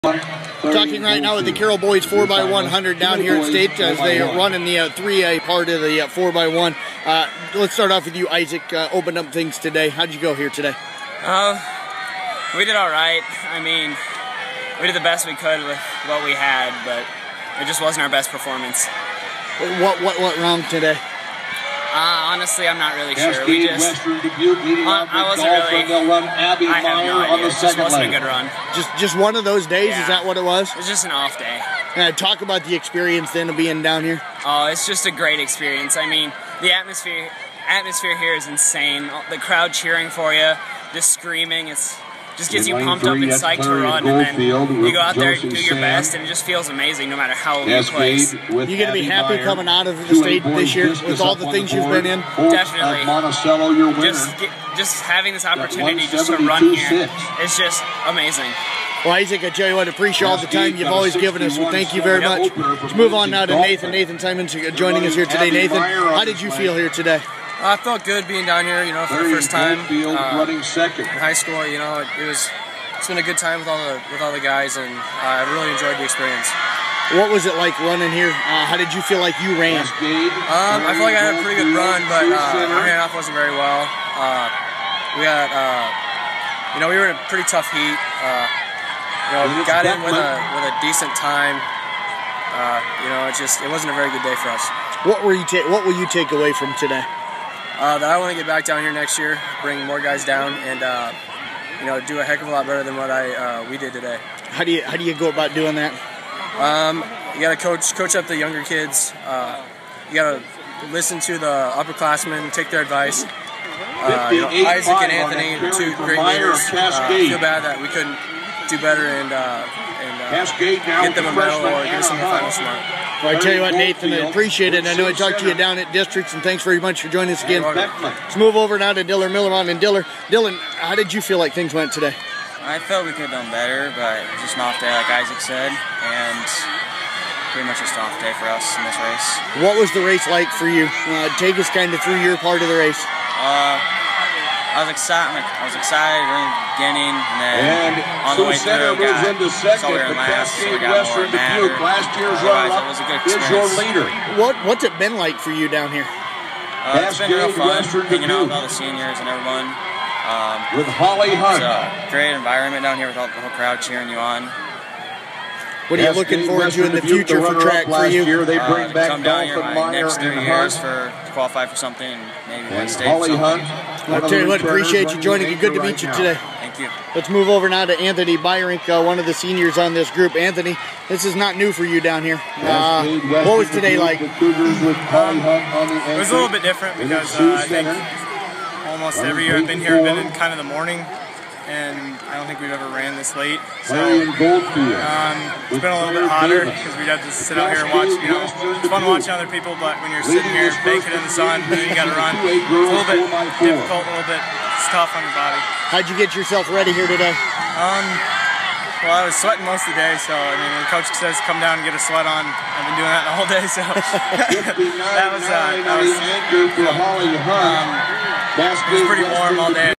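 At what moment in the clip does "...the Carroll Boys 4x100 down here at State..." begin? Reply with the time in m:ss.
0:01.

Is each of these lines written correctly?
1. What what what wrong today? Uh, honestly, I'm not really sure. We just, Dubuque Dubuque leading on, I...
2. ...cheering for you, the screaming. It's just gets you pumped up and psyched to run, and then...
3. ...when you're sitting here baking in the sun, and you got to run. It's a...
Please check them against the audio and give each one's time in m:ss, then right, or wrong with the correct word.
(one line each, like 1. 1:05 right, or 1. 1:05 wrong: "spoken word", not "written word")
1. 0:19 wrong: "Western", not "Dubuque"
2. 0:39 right
3. 3:20 right.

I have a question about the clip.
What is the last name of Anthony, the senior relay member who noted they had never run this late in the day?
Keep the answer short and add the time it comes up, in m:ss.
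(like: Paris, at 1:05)
Byrink, at 2:58.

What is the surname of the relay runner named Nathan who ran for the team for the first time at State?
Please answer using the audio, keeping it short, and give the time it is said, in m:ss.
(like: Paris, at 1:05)
Simons, at 1:04.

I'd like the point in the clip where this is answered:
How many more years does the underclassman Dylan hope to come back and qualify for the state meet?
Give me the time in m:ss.
2:50.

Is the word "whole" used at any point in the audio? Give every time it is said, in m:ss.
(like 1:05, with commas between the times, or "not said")
2:43, 3:33.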